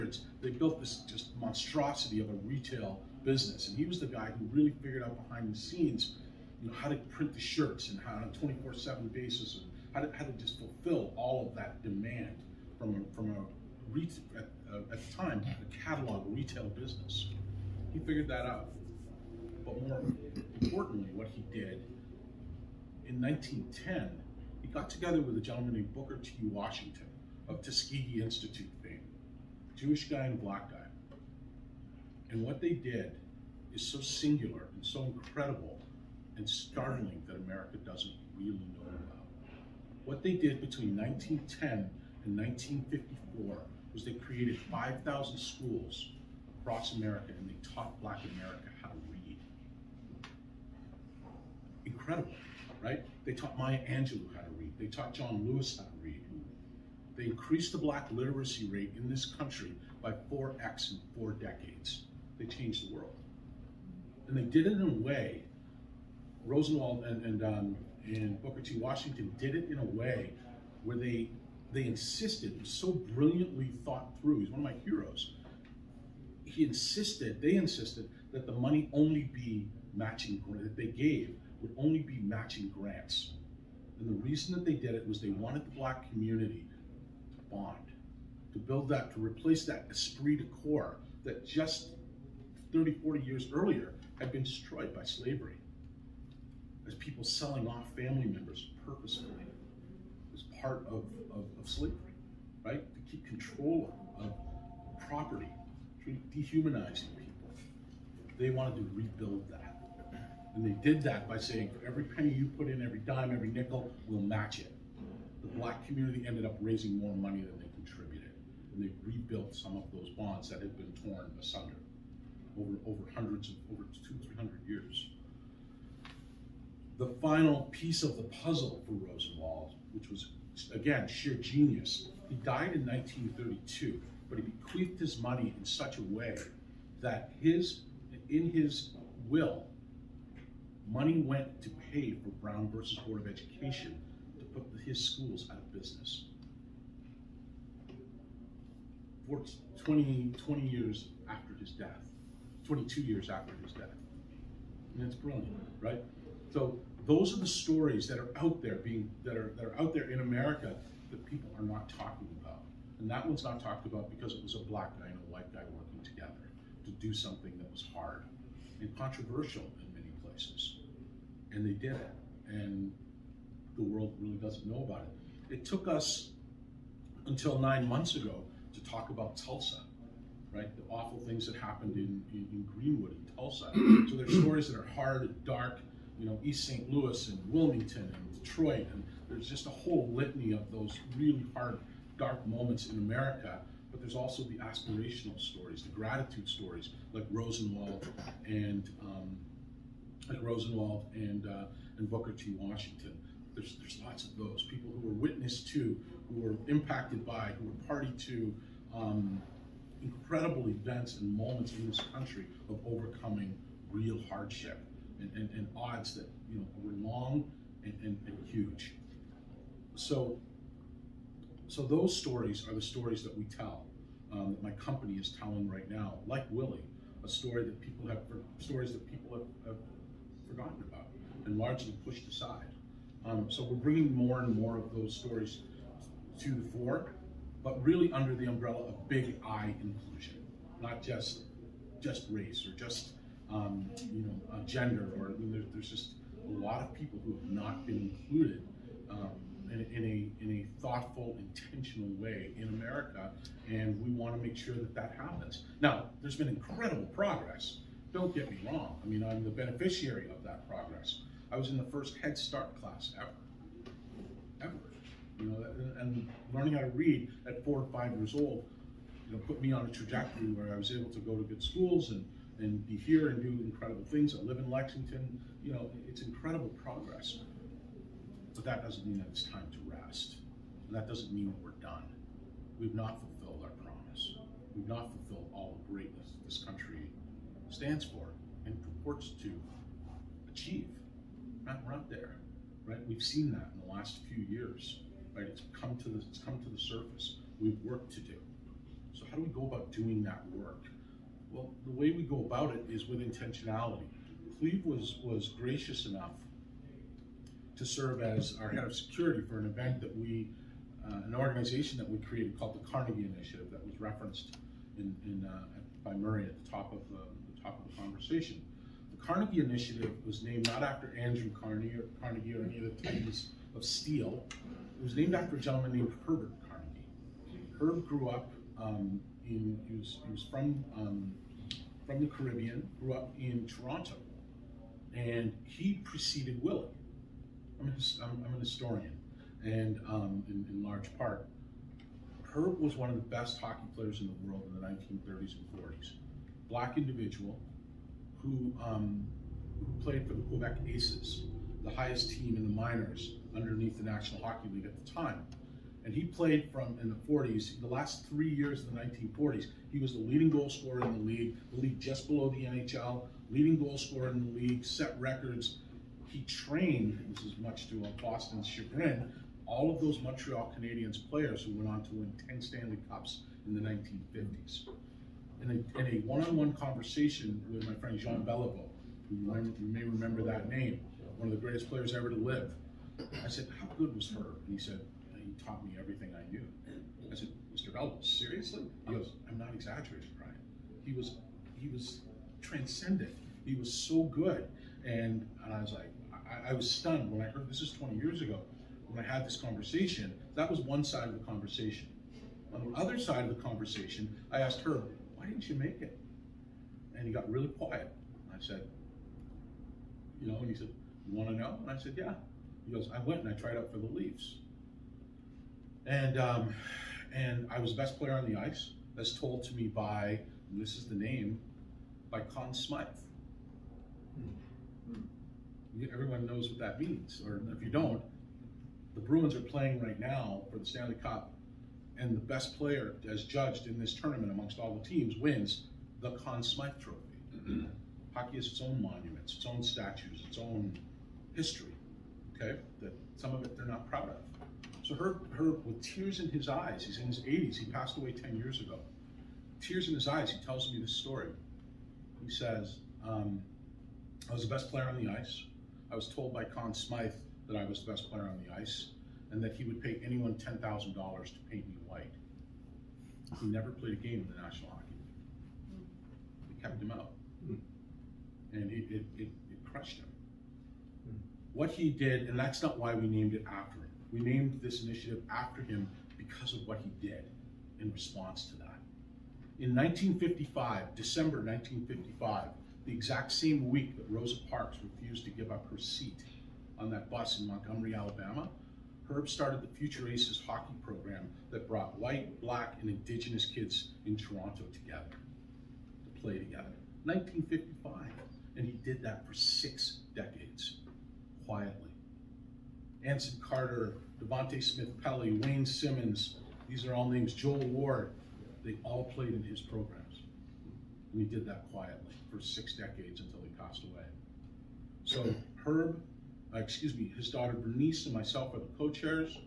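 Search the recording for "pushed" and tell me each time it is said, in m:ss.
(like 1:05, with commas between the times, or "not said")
3:52.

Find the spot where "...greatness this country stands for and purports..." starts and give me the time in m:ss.
4:45.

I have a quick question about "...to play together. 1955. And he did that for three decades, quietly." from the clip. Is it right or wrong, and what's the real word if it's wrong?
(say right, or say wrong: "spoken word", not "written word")
wrong: "six", not "three".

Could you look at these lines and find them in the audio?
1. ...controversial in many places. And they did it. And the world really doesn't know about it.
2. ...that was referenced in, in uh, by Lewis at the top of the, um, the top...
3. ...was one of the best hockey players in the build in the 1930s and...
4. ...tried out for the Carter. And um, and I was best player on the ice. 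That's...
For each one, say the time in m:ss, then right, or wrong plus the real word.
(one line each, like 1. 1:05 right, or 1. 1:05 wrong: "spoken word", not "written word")
1. 2:48 right
2. 5:13 wrong: "Murray", not "Lewis"
3. 5:42 wrong: "world", not "build"
4. 6:53 wrong: "Leafs", not "Carter".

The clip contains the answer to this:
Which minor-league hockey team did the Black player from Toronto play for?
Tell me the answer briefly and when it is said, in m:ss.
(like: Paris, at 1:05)
Quebec Aces, at 5:50.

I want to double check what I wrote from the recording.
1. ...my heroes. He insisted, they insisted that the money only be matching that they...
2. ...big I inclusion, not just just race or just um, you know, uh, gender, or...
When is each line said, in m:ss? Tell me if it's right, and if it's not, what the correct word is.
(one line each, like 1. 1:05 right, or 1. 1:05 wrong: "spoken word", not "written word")
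1. 1:14 right
2. 3:59 right.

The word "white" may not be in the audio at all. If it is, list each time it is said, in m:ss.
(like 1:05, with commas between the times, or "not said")
2:45, 7:42, 8:12.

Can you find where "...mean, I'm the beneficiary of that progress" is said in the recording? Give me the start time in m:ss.
4:19.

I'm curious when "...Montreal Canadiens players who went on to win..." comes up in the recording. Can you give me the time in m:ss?
6:10.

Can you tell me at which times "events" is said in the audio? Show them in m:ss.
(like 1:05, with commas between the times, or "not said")
3:30, 5:09.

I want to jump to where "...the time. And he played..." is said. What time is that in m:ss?
5:55.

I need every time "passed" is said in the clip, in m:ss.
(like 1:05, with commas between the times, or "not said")
7:27, 8:33.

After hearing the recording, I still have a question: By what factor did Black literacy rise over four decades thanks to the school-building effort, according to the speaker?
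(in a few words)
4x.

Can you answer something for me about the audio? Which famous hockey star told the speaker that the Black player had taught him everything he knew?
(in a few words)
Jean Beliveau.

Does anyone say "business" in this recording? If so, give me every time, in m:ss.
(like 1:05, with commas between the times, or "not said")
0:03, 0:16, 2:25.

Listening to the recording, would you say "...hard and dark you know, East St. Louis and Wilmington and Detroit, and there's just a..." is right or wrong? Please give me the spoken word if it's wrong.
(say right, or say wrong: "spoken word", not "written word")
right.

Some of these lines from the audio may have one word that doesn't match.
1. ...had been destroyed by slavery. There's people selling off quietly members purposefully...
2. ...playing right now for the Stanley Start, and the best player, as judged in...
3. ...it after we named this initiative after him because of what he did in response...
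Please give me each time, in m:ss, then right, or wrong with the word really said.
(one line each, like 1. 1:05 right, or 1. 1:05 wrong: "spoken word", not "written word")
1. 1:34 wrong: "family", not "quietly"
2. 7:09 wrong: "Cup", not "Start"
3. 7:53 right.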